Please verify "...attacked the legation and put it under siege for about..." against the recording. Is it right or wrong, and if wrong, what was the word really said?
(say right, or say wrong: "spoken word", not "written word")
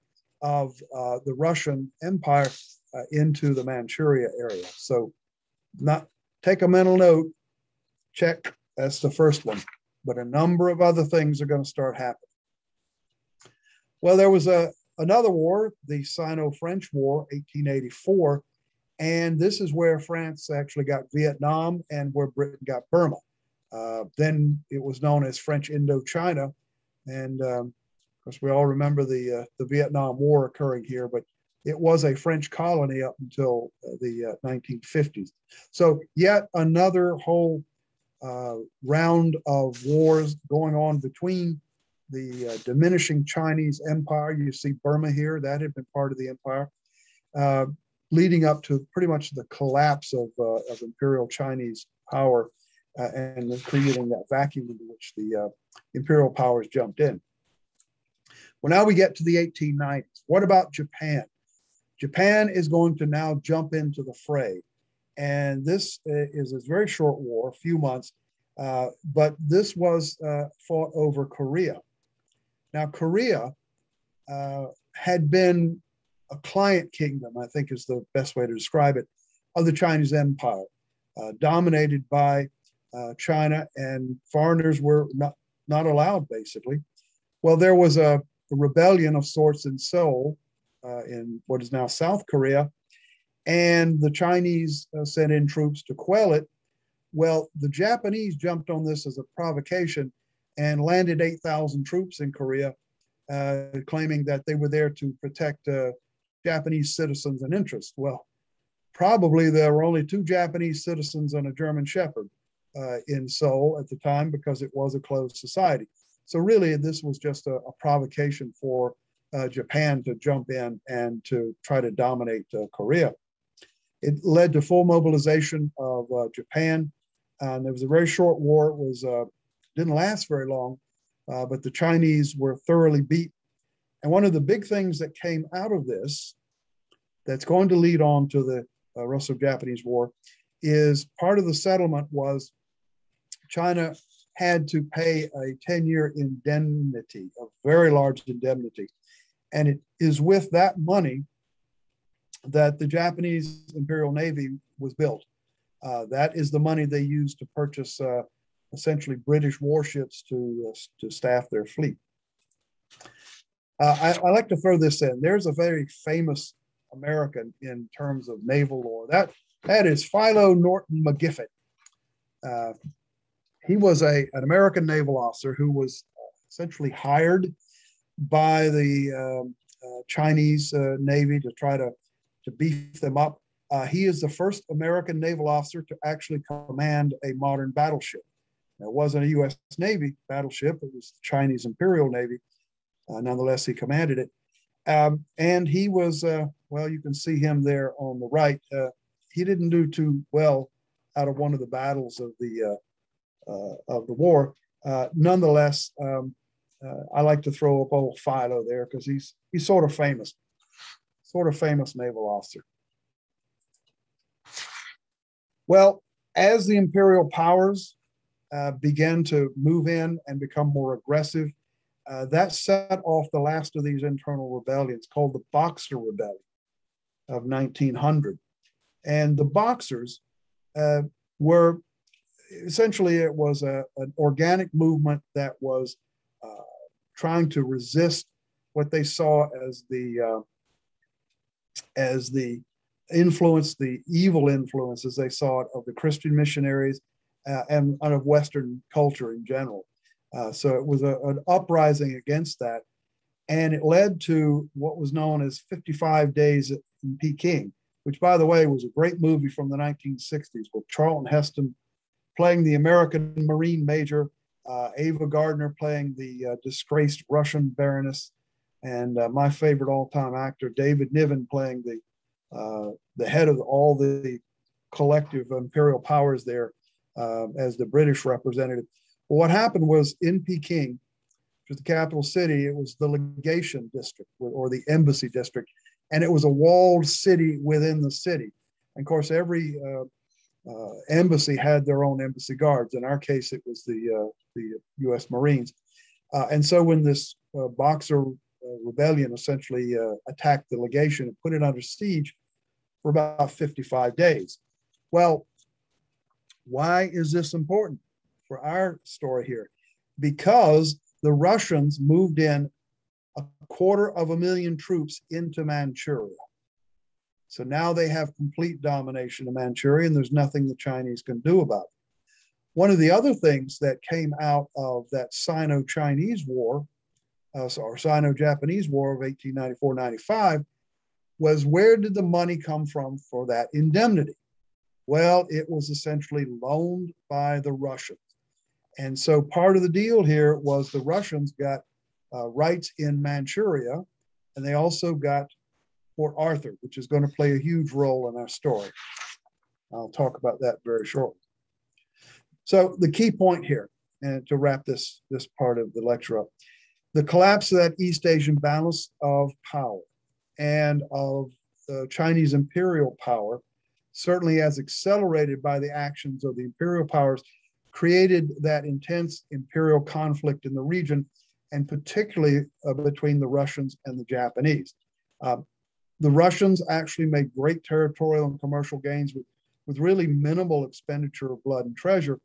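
right.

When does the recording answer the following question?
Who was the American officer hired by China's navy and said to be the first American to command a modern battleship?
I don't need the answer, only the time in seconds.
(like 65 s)
170 s.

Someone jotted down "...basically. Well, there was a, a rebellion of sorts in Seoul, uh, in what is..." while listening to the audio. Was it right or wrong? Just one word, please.
right.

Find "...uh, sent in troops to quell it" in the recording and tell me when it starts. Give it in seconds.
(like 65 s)
94 s.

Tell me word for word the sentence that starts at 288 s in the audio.
And of course, every uh, uh, embassy had their own embassy guards.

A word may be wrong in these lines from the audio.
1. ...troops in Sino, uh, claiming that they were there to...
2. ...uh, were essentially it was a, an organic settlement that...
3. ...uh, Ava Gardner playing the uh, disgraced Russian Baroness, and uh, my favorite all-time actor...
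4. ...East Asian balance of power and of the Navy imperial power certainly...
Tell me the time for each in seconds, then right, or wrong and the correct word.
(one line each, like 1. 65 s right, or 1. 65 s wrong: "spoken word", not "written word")
1. 101 s wrong: "Korea", not "Sino"
2. 230 s wrong: "movement", not "settlement"
3. 264 s right
4. 358 s wrong: "Chinese", not "Navy".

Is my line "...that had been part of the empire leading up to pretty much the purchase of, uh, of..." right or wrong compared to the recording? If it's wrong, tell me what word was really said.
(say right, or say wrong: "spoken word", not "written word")
wrong: "collapse", not "purchase".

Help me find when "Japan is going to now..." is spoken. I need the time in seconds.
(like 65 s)
62 s.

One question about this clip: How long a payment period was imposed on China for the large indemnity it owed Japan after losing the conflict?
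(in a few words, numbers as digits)
10 year.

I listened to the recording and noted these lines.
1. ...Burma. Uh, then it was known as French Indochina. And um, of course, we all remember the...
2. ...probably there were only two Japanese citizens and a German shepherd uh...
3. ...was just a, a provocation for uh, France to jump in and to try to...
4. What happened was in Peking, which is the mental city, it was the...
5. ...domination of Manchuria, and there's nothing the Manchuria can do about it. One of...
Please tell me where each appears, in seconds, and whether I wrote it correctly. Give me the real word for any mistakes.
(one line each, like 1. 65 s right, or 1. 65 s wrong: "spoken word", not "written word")
1. 22 s right
2. 108 s right
3. 117 s wrong: "Japan", not "France"
4. 279 s wrong: "capital", not "mental"
5. 318 s wrong: "Chinese", not "Manchuria".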